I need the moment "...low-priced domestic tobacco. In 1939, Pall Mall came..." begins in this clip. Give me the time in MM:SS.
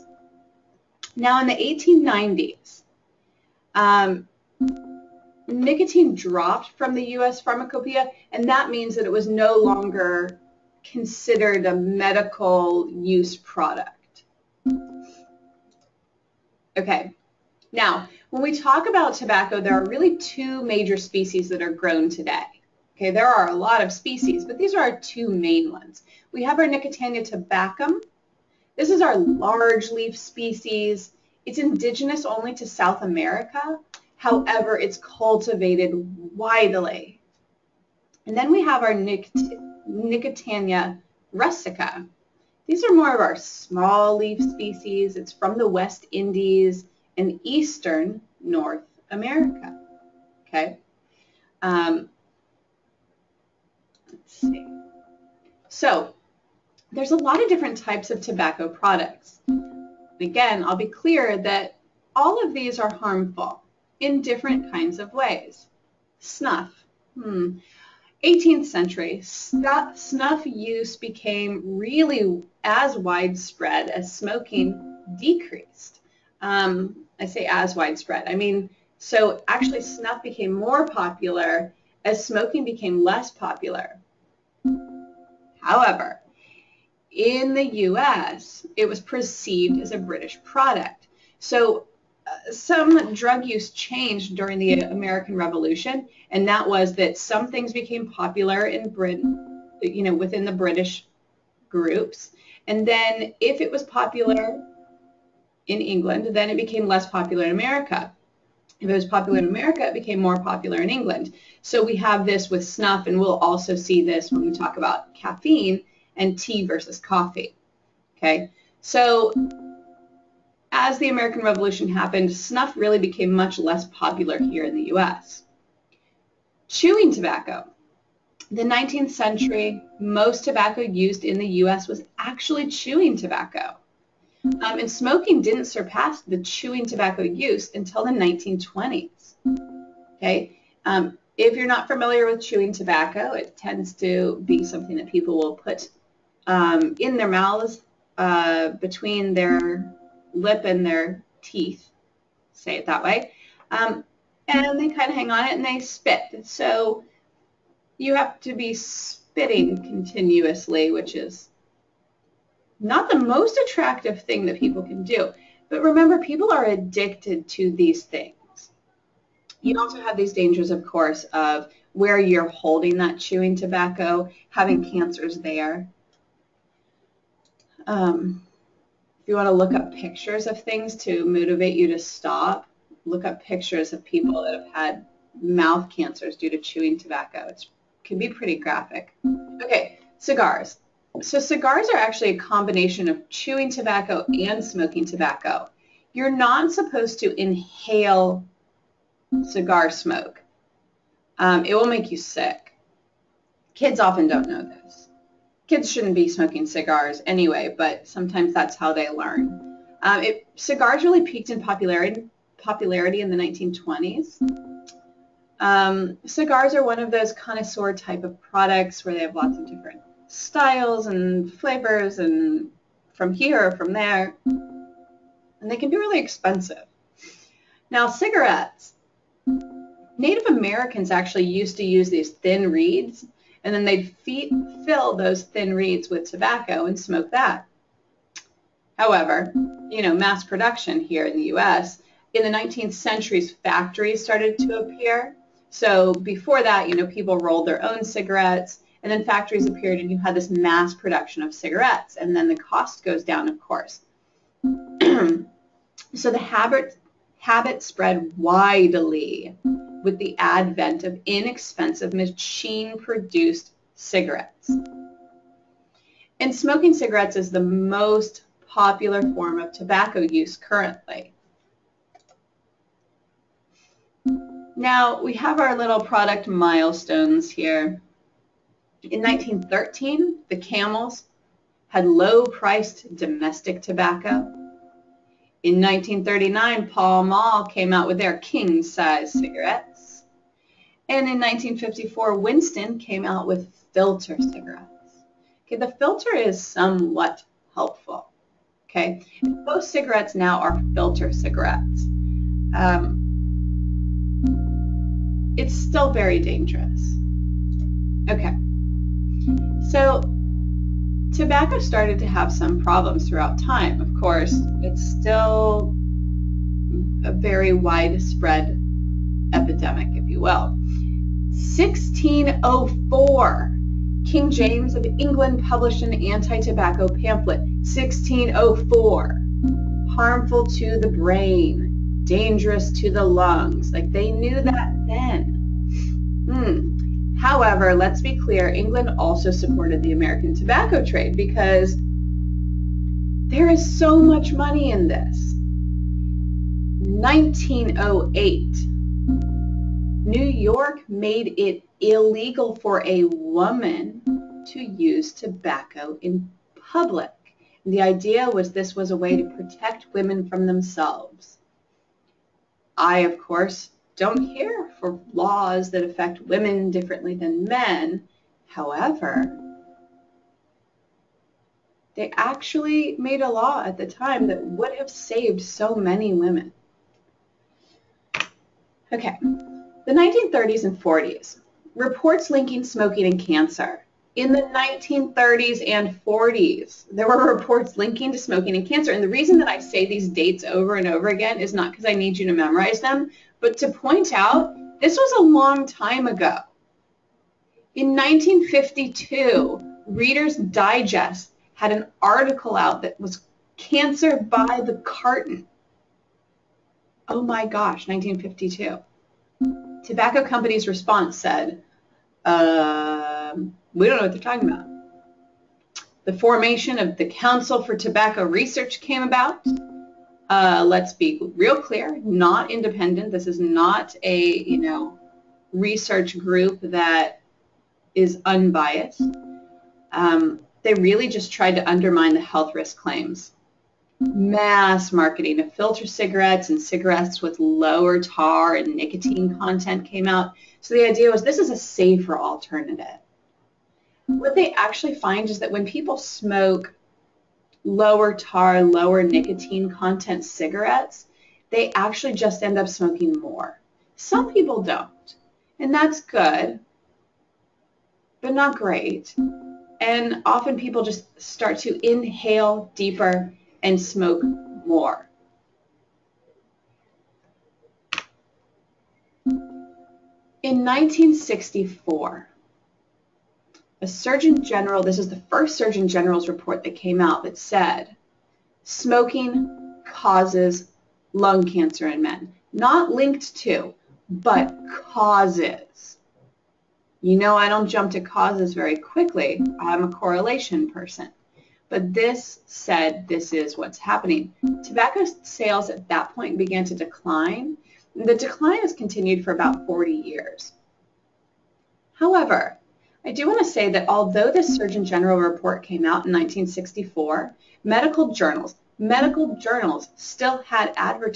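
04:42.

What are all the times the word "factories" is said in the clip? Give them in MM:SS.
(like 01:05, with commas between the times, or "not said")
04:03, 04:09.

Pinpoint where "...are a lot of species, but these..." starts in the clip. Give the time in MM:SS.
00:23.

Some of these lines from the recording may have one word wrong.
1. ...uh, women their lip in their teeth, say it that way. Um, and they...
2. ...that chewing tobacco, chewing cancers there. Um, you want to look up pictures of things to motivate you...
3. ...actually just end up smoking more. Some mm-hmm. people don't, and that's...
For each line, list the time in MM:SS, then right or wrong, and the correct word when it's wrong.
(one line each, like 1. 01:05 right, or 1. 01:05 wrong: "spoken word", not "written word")
1. 02:28 wrong: "between", not "women"
2. 02:52 wrong: "having", not "chewing"
3. 07:31 right.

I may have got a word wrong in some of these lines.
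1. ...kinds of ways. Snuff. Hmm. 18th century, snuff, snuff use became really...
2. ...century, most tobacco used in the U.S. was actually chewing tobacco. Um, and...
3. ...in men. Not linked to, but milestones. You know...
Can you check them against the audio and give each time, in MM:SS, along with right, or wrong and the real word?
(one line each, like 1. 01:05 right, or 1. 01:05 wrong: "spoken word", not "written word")
1. 01:04 right
2. 02:09 right
3. 08:02 wrong: "causes", not "milestones".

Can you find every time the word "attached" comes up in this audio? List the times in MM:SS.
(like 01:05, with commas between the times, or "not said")
not said.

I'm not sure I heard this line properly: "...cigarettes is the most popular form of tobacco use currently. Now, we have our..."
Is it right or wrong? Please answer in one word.
right.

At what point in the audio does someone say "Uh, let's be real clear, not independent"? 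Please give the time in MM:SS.
07:00.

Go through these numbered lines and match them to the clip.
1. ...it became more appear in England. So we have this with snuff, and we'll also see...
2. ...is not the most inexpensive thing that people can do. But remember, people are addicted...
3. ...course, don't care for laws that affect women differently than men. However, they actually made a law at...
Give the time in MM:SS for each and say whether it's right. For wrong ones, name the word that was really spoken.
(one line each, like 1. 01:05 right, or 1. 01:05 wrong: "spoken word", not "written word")
1. 01:49 wrong: "popular", not "appear"
2. 02:41 wrong: "attractive", not "inexpensive"
3. 06:03 right.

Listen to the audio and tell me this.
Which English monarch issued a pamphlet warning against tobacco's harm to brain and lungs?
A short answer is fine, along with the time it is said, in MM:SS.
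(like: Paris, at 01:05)
King James, at 05:24.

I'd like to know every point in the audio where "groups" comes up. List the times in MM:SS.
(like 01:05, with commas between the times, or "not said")
01:41, 07:06.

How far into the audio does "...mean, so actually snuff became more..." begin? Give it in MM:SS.
01:18.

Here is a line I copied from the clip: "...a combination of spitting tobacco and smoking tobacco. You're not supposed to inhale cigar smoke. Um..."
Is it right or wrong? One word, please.
wrong.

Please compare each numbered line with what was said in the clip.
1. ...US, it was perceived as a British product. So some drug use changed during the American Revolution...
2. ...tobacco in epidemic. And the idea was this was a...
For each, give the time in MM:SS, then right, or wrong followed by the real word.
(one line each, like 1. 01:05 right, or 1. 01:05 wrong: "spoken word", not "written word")
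1. 01:27 right
2. 05:55 wrong: "public", not "epidemic".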